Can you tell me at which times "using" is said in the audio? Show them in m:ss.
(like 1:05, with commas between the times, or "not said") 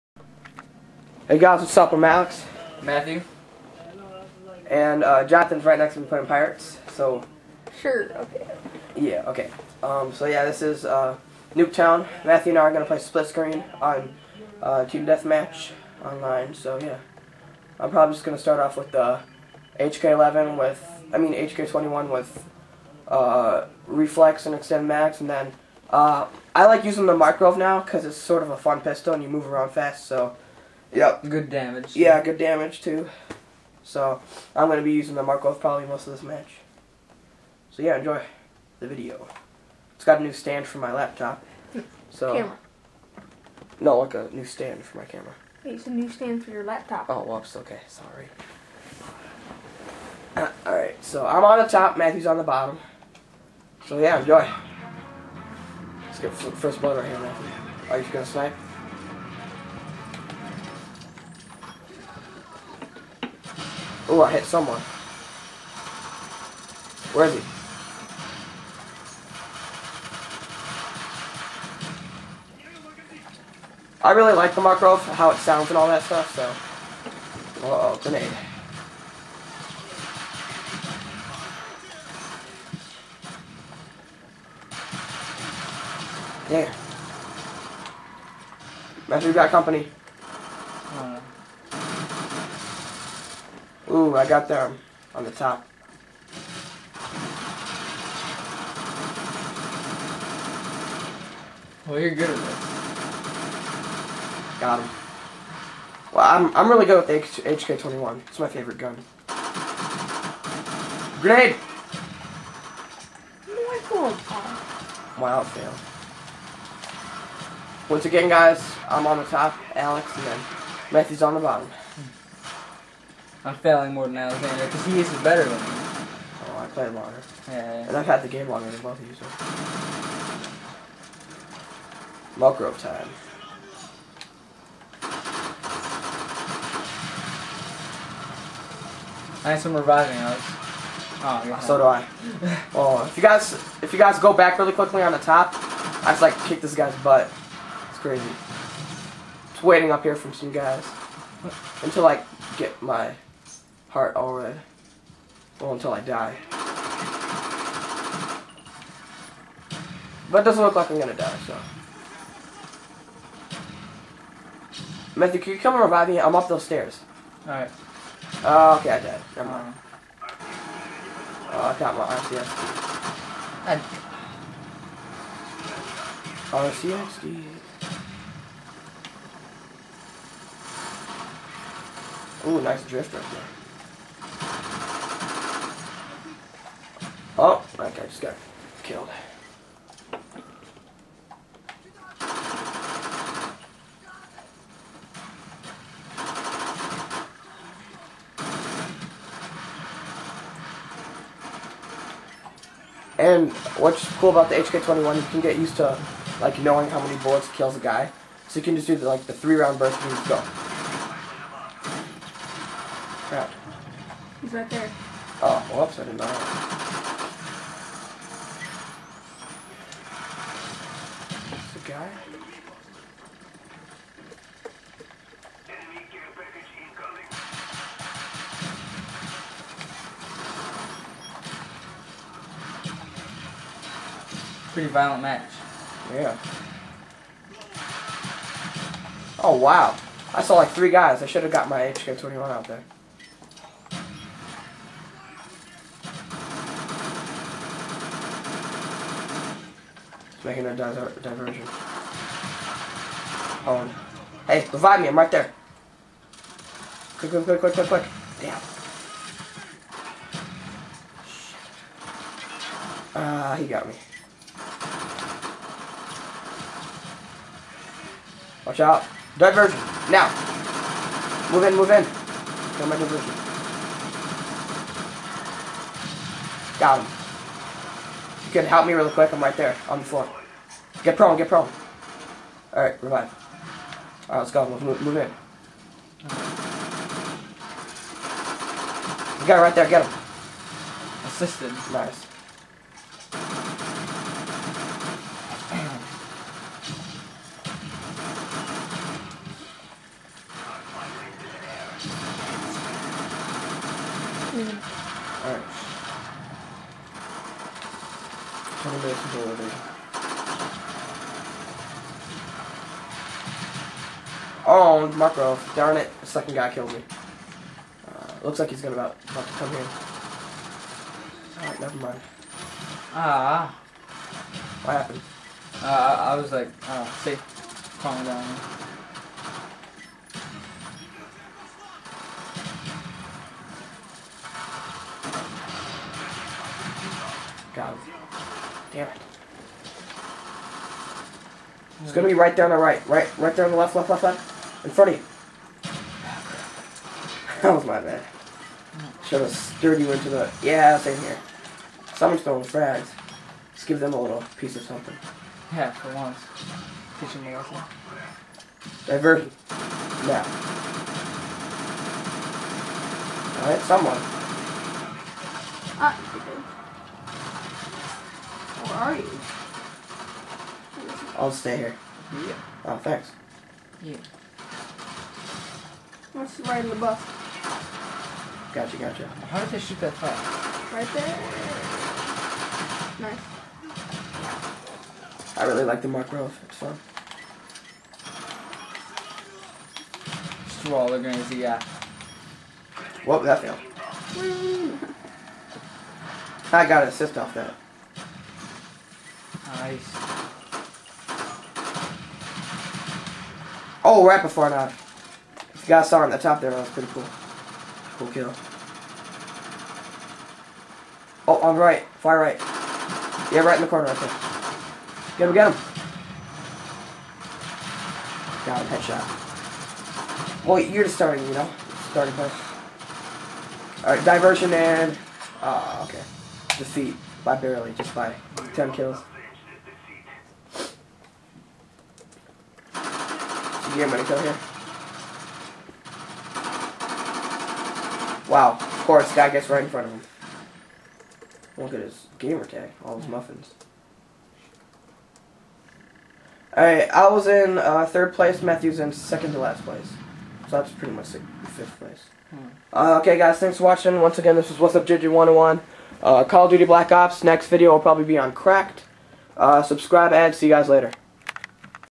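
0:26, 0:34.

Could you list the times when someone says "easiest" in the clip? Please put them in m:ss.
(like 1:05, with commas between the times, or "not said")
not said.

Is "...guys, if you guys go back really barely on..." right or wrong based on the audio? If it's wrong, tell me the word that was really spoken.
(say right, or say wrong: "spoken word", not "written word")
wrong: "quickly", not "barely".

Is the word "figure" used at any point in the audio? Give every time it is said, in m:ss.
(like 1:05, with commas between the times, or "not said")
not said.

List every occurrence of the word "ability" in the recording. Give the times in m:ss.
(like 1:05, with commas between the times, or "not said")
5:09.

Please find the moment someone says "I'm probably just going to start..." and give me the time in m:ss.
0:17.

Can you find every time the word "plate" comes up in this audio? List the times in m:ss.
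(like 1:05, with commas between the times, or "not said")
not said.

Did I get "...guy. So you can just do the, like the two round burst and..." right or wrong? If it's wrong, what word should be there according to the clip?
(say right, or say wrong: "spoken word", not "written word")
wrong: "three", not "two".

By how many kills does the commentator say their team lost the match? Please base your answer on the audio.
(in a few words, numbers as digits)
10.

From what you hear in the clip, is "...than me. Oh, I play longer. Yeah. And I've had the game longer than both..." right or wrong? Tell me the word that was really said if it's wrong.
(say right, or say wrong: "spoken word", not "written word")
right.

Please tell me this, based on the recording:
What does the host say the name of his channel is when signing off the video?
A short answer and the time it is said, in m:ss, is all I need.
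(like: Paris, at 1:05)
What's Up JJ101, at 7:34.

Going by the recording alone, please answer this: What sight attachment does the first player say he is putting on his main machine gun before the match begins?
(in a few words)
Reflex.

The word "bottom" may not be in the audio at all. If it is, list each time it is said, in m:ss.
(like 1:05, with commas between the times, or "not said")
0:52, 2:01.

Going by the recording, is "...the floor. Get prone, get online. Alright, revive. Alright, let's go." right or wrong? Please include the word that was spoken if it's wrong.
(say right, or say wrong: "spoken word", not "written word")
wrong: "prone", not "online".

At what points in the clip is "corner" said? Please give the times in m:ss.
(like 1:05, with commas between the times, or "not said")
6:53.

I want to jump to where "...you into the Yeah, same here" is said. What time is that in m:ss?
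5:49.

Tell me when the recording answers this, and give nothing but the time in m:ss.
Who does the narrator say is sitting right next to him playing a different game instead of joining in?
0:05.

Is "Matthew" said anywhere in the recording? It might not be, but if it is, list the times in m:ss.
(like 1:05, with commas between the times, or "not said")
0:02, 0:12, 0:51, 0:57, 2:00, 2:45, 7:28.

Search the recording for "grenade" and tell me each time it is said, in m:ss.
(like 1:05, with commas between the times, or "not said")
1:18, 1:51, 6:31.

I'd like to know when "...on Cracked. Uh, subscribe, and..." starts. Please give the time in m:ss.
7:38.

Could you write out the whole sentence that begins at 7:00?
Well, you're just starting, you know?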